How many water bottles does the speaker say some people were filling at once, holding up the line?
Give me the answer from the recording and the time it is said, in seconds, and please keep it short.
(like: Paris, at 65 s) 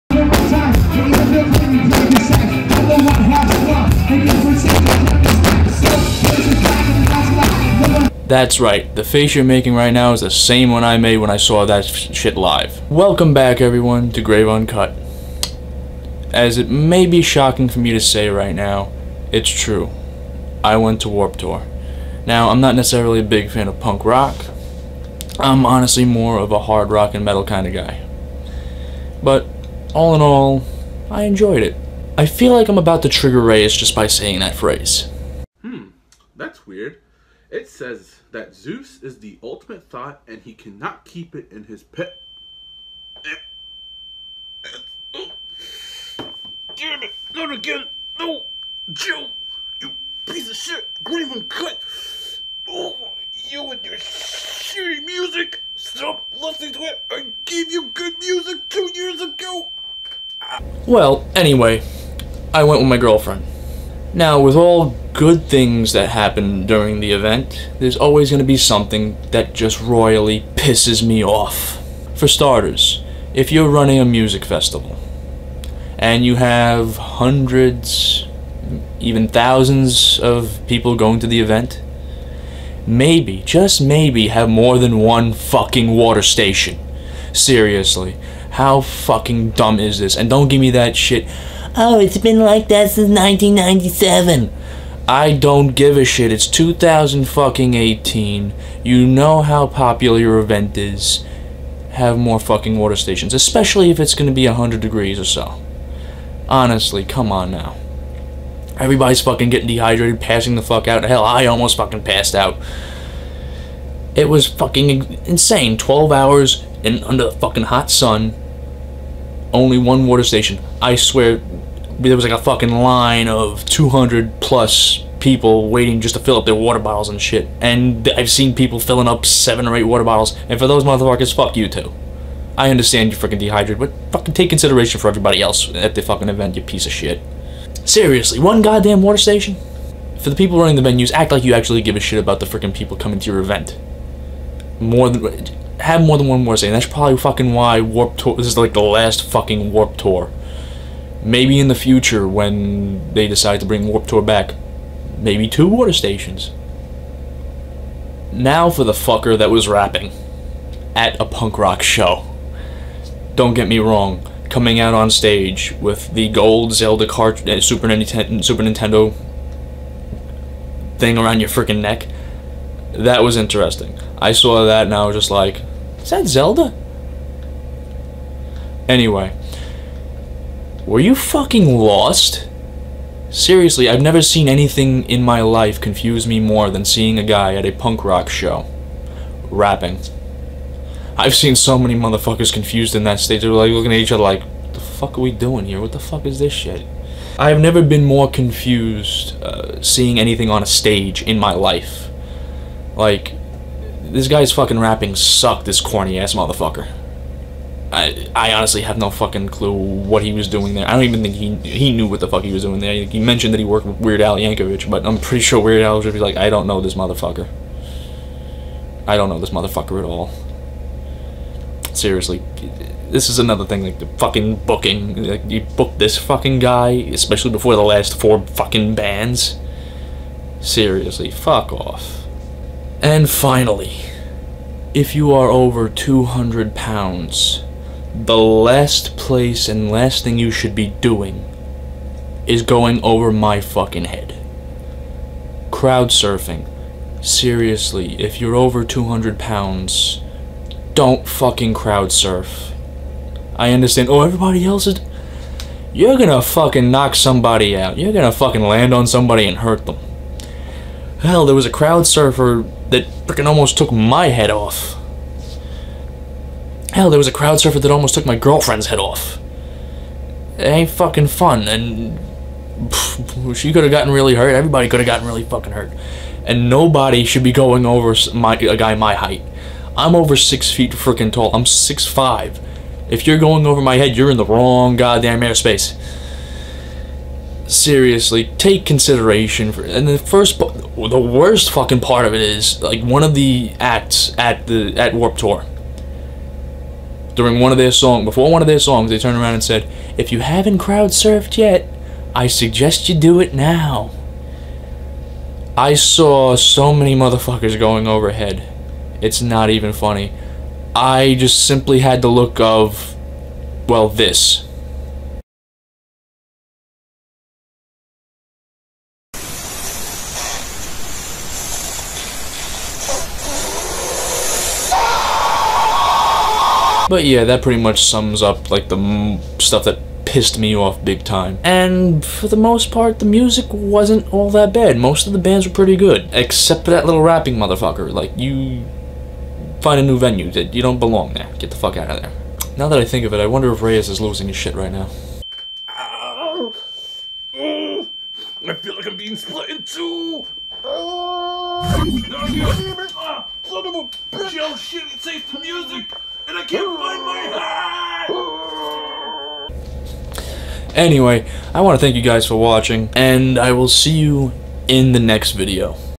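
7 or 8, at 129 s.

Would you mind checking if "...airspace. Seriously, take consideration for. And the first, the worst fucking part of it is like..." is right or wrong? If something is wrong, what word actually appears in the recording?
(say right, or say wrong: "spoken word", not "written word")
right.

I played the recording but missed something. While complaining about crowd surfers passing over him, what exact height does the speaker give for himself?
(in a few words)
6'5".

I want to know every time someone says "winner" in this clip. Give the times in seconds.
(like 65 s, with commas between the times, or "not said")
not said.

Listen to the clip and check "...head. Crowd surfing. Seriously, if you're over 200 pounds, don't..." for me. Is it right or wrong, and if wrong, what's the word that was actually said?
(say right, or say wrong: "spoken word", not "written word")
right.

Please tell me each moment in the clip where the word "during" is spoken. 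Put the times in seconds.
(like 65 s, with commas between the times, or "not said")
66 s, 297 s.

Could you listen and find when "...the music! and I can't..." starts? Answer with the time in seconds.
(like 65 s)
355 s.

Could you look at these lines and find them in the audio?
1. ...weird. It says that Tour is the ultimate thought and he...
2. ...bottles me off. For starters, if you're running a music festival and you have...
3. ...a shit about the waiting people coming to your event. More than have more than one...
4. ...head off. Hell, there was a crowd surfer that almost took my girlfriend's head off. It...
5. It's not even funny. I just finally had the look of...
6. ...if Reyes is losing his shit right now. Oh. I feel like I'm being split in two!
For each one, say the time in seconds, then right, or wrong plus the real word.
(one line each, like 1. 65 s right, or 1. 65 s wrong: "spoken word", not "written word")
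1. 36 s wrong: "Zeus", not "Tour"
2. 70 s wrong: "pisses", not "bottles"
3. 141 s wrong: "freaking", not "waiting"
4. 264 s right
5. 309 s wrong: "simply", not "finally"
6. 343 s right.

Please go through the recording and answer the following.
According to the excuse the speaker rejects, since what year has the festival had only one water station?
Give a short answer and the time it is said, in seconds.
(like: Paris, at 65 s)
1997, at 93 s.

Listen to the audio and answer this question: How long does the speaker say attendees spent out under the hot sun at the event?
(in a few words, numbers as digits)
12 hours.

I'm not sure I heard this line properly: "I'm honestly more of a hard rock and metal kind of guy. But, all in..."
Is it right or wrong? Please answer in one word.
right.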